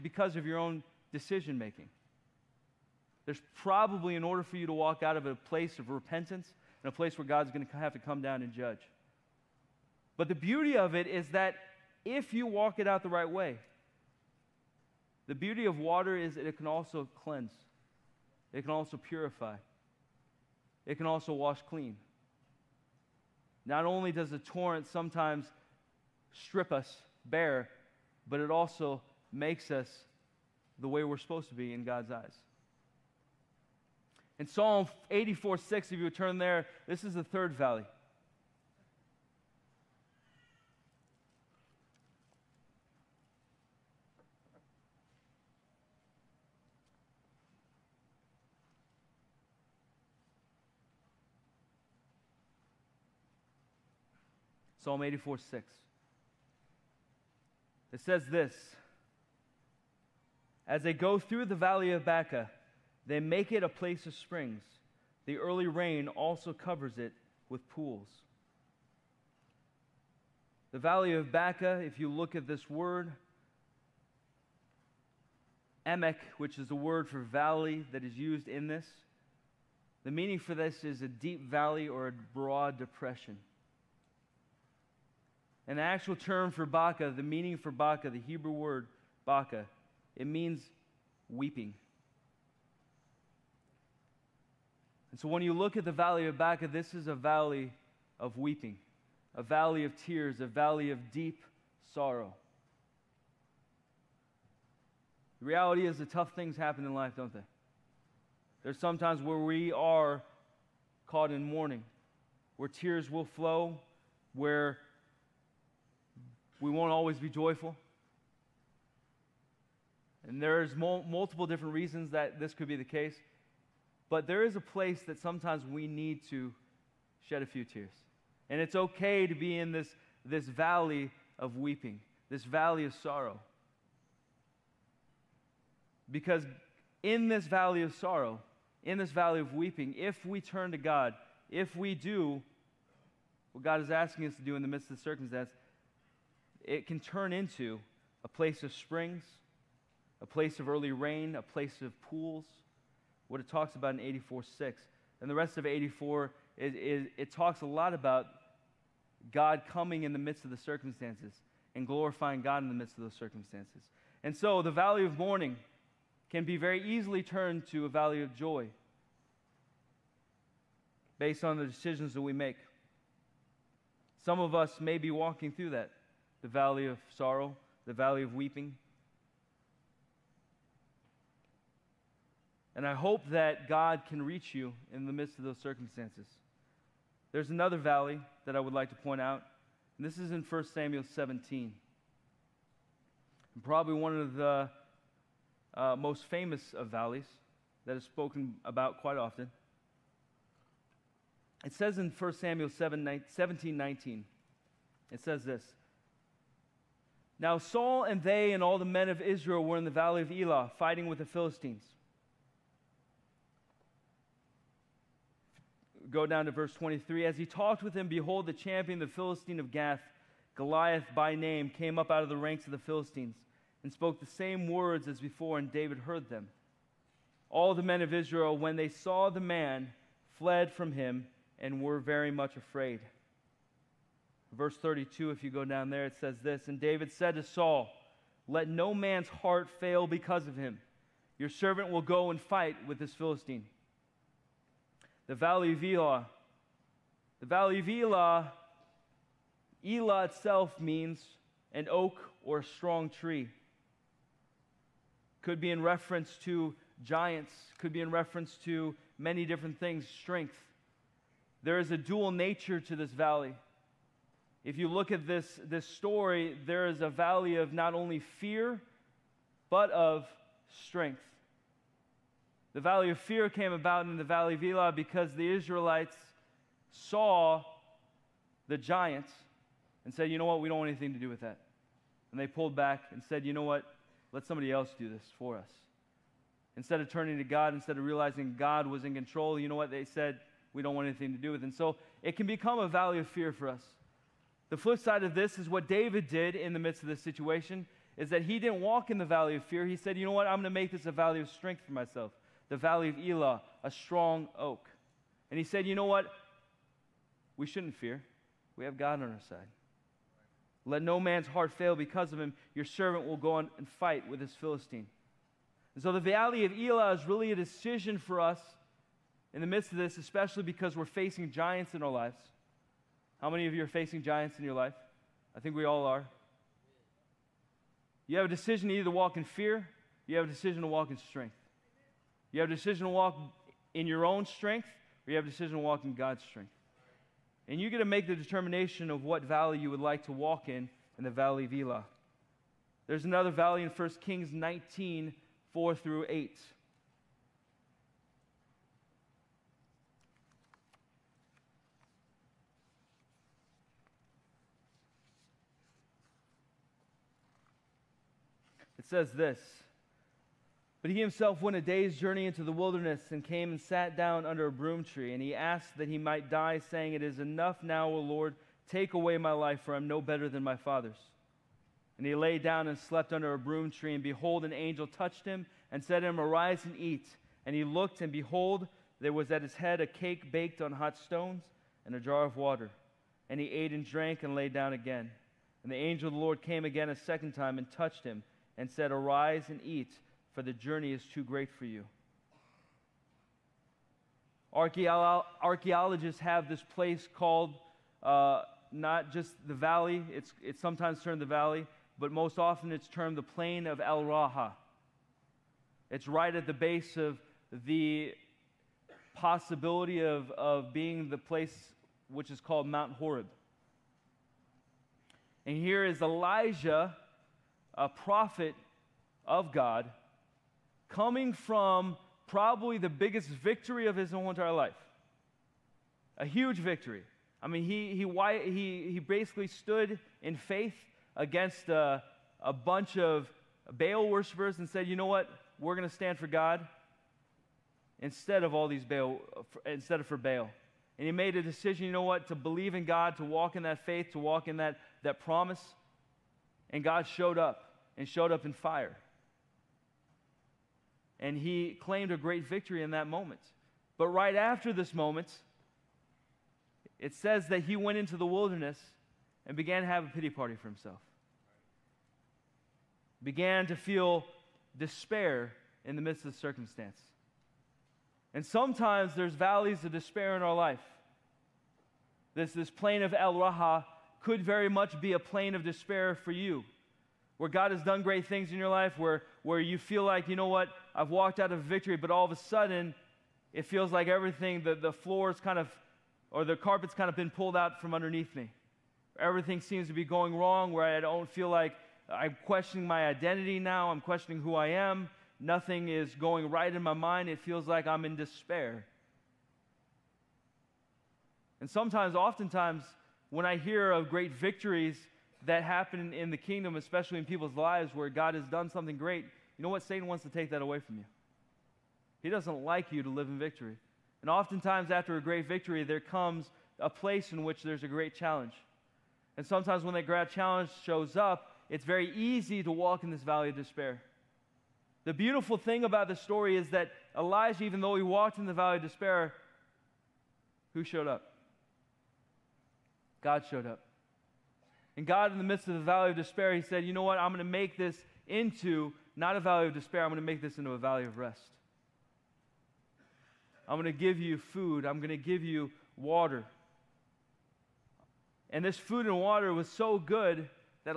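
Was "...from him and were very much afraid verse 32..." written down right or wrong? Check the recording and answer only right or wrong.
right.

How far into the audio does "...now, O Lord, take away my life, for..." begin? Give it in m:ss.
6:07.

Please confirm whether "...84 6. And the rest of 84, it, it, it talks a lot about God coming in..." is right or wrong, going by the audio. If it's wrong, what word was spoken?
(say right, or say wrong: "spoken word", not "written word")
right.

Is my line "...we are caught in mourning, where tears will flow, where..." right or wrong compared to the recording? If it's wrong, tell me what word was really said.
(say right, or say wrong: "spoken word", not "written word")
right.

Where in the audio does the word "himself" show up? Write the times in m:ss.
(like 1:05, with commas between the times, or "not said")
6:01, 7:40.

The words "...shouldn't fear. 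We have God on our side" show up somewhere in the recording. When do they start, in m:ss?
5:07.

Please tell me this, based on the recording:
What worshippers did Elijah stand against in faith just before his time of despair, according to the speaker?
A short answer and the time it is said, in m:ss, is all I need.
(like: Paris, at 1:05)
Baal worshippers, at 7:13.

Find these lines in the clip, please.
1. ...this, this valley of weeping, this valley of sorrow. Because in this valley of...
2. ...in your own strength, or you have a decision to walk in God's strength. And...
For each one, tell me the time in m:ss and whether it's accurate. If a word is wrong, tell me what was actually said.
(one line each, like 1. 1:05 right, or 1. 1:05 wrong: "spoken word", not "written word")
1. 2:09 right
2. 5:33 right.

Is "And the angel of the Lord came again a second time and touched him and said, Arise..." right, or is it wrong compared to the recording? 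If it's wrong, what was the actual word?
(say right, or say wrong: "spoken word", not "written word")
right.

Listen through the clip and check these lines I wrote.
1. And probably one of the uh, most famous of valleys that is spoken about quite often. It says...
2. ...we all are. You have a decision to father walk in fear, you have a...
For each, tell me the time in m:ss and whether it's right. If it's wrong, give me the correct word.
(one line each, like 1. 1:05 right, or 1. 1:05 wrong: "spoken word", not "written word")
1. 3:13 right
2. 5:25 wrong: "either", not "father".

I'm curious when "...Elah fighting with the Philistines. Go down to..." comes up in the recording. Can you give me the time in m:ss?
3:30.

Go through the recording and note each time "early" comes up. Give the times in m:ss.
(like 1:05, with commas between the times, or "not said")
1:05, 2:30.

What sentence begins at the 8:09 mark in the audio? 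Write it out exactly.
Everything seems to be going wrong, where I don't feel like I'm questioning my identity now, I'm questioning who I am.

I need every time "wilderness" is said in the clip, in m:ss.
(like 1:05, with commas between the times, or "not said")
6:02, 7:38.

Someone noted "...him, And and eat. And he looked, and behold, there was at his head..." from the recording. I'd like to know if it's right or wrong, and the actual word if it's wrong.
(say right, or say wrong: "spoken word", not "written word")
wrong: "Arise", not "And".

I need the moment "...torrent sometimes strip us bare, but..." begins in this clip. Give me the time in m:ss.
0:24.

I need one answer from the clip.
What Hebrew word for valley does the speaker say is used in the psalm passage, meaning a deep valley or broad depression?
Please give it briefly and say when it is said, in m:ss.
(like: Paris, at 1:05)
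emek, at 1:15.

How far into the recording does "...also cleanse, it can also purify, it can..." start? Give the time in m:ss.
0:16.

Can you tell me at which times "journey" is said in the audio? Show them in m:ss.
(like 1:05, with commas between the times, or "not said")
6:02, 6:30.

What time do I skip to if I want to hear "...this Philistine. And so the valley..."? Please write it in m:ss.
5:14.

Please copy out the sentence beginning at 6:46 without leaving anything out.
It's right at the base of the possibility of, of being the place which is called Mount Horeb.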